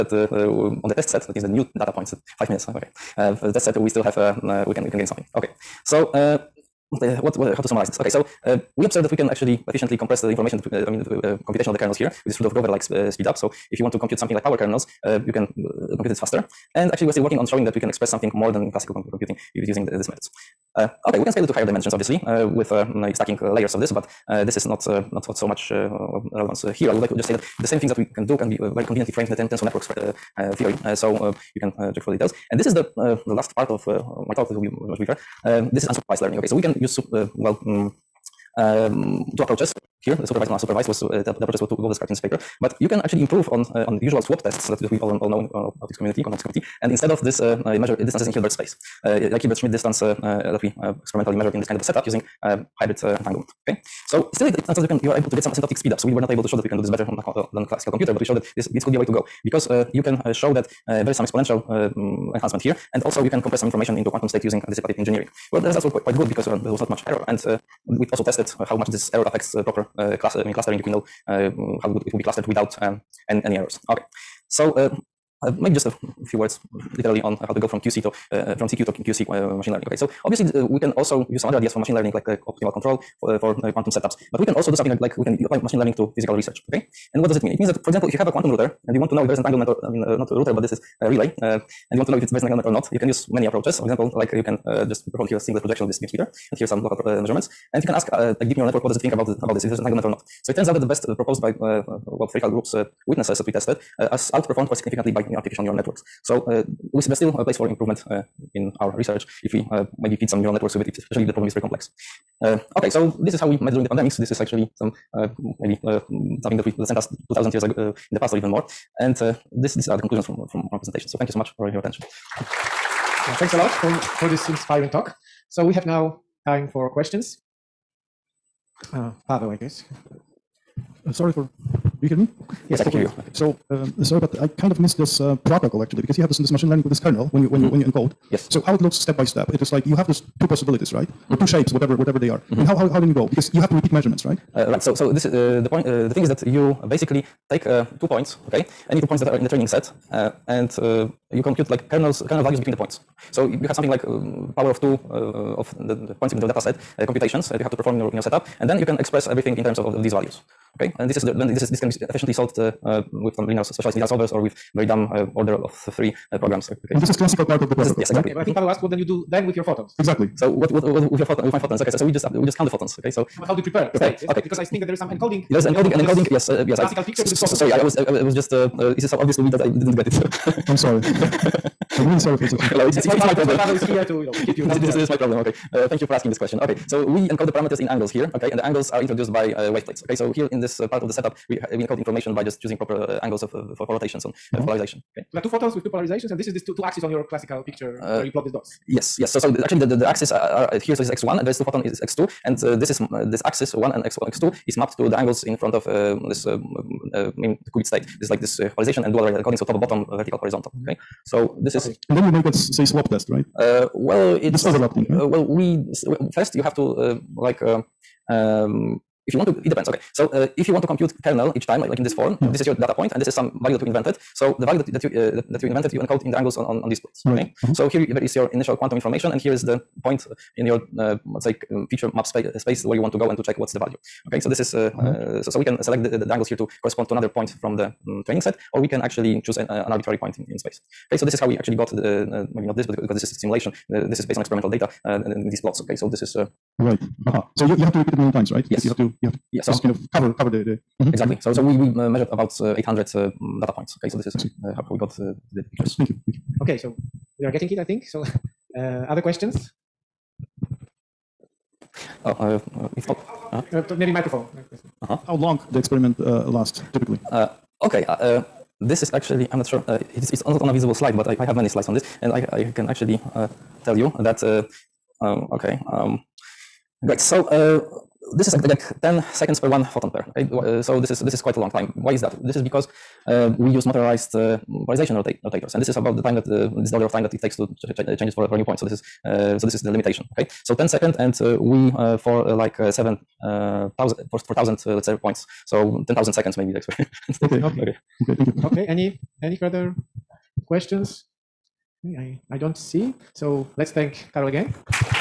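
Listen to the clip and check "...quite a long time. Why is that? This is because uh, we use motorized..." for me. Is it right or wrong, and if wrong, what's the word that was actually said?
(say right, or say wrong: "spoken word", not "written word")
right.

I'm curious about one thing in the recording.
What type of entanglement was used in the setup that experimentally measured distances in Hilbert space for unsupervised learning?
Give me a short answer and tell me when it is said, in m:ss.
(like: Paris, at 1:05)
Hybrid entanglement, at 0:52.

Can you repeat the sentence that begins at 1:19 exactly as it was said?
Okay, so obviously we can also use some other ideas for machine learning, like optimal control, for uh, quantum setups.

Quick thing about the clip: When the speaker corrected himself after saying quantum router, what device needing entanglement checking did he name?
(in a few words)
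A relay.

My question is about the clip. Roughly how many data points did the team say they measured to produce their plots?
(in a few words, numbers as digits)
800.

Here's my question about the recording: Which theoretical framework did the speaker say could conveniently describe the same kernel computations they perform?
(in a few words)
Tensor networks.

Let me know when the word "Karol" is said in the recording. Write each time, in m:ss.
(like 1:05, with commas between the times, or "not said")
5:04.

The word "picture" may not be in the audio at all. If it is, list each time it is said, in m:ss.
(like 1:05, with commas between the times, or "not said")
2:57, 3:17, 4:15.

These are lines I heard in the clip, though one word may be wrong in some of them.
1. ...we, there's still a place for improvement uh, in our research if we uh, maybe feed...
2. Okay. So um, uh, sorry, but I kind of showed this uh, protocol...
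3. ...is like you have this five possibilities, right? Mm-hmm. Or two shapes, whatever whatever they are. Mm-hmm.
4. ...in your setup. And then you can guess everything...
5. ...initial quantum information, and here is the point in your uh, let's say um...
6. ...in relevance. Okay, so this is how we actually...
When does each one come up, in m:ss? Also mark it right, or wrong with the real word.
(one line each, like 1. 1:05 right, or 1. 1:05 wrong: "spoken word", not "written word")
1. 1:46 right
2. 2:13 wrong: "missed", not "showed"
3. 2:19 wrong: "two", not "five"
4. 2:38 wrong: "express", not "guess"
5. 3:48 right
6. 4:00 wrong: "space", not "relevance".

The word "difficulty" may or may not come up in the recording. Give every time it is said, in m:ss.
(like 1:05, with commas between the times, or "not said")
not said.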